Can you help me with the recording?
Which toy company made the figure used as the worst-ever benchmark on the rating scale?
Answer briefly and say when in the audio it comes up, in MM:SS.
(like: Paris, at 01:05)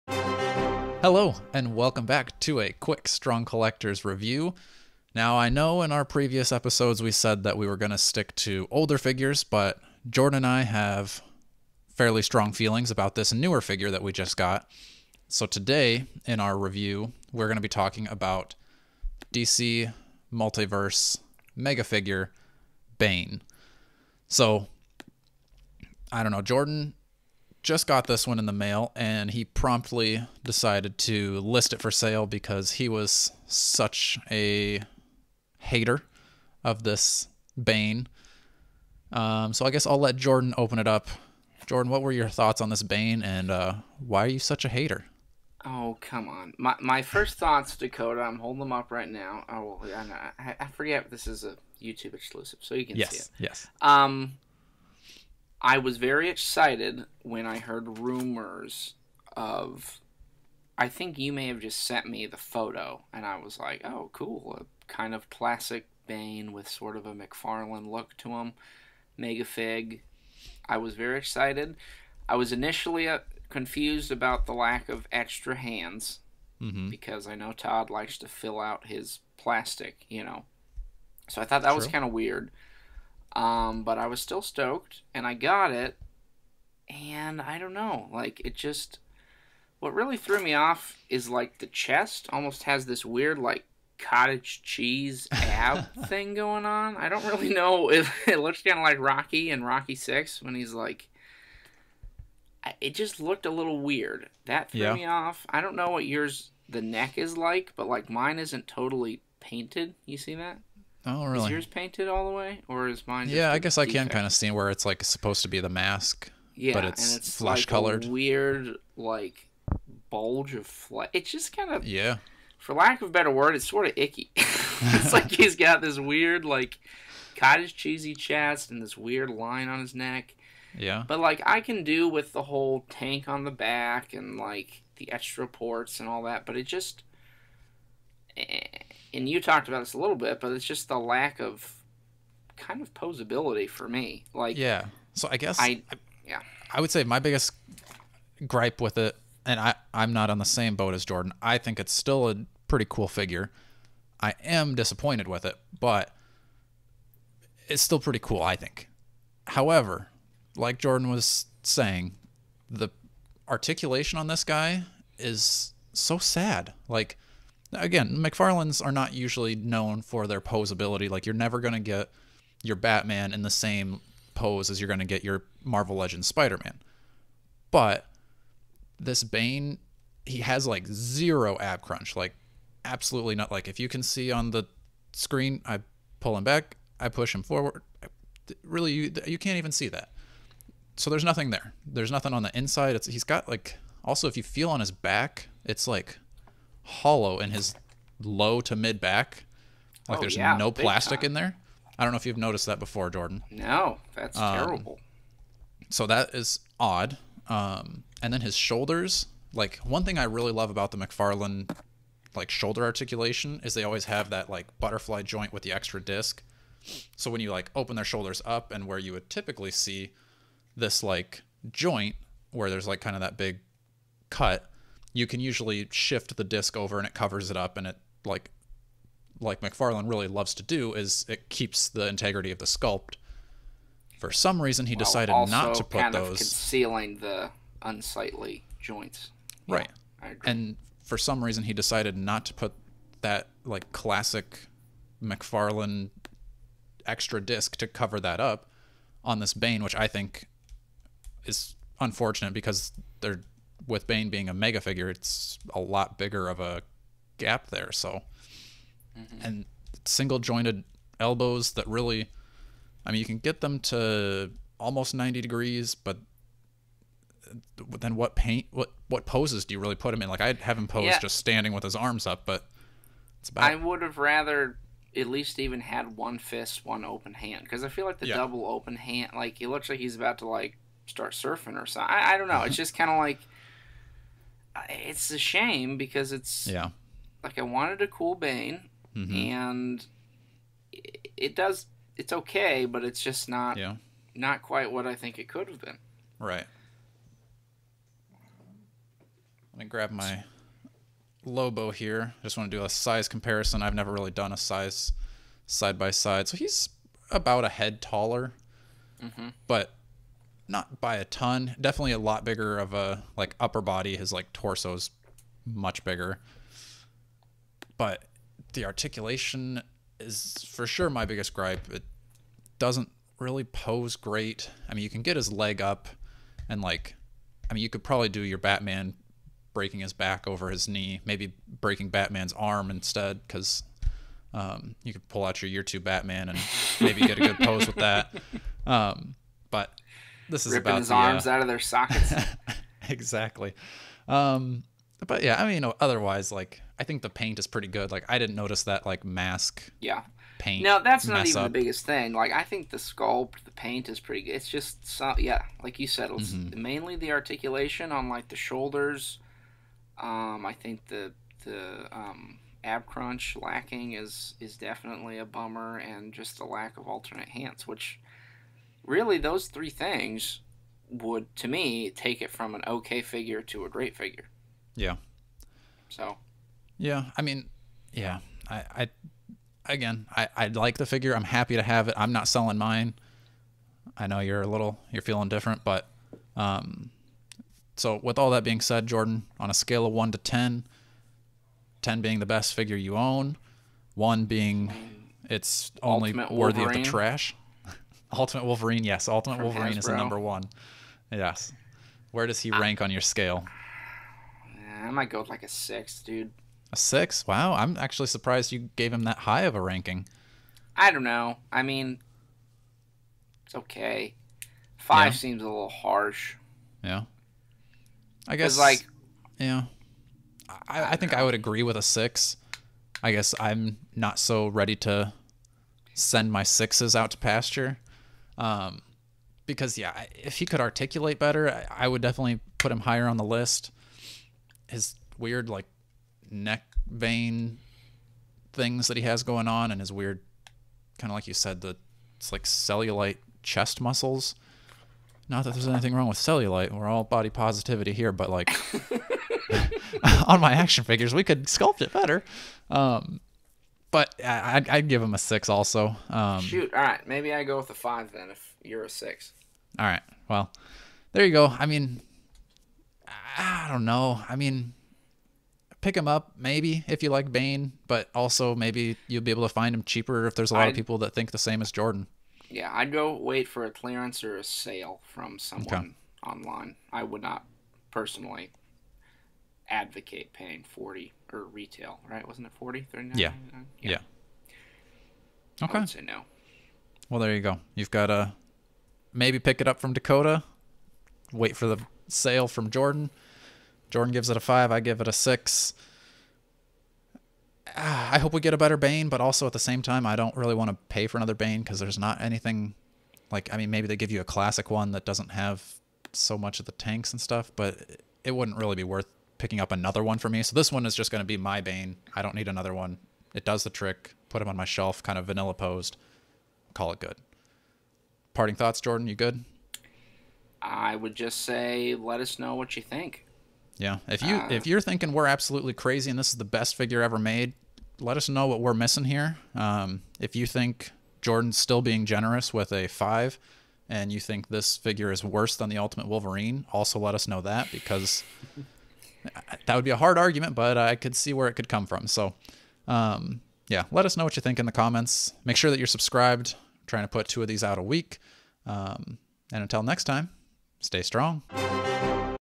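Hasbro, at 06:39.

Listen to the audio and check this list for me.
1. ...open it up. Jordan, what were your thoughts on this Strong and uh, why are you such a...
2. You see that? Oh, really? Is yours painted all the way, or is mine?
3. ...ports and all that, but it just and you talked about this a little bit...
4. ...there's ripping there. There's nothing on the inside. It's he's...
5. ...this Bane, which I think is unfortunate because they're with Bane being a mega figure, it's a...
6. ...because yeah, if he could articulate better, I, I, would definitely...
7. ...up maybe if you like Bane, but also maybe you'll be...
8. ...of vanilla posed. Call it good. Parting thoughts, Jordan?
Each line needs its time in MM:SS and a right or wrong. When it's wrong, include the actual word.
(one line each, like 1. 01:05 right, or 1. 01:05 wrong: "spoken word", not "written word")
1. 00:40 wrong: "Bane", not "Strong"
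2. 01:50 right
3. 02:15 right
4. 03:11 wrong: "nothing", not "ripping"
5. 04:09 right
6. 07:09 right
7. 07:46 right
8. 08:35 right.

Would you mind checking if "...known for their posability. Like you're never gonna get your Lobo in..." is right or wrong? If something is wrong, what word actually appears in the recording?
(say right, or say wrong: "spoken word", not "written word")
wrong: "Batman", not "Lobo".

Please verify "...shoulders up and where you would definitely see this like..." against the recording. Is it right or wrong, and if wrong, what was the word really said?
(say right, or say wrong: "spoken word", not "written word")
wrong: "typically", not "definitely".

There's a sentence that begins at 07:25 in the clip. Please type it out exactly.
Not that there's anything wrong with cellulite.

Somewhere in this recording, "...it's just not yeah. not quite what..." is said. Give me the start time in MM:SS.
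04:53.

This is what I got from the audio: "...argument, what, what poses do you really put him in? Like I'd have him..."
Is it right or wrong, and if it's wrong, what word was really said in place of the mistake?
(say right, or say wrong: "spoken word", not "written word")
wrong: "paint", not "argument".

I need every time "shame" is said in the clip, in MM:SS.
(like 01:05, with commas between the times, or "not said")
04:45.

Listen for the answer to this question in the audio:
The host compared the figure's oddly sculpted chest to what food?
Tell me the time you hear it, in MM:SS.
01:33.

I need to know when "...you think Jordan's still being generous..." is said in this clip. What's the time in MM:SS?
08:50.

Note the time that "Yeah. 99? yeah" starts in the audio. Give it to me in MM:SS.
08:03.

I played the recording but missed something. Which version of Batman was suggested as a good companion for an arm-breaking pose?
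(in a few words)
Year two Batman.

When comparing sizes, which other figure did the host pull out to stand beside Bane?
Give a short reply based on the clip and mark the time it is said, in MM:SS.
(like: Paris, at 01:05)
Lobo, at 05:01.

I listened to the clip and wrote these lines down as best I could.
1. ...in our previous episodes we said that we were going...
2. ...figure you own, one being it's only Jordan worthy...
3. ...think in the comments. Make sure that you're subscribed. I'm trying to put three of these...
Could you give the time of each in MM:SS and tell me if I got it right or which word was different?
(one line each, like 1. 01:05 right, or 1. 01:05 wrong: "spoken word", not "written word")
1. 00:05 right
2. 06:32 wrong: "Ultimate", not "Jordan"
3. 09:04 wrong: "two", not "three".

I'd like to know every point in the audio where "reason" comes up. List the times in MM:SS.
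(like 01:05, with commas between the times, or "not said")
03:54, 04:01.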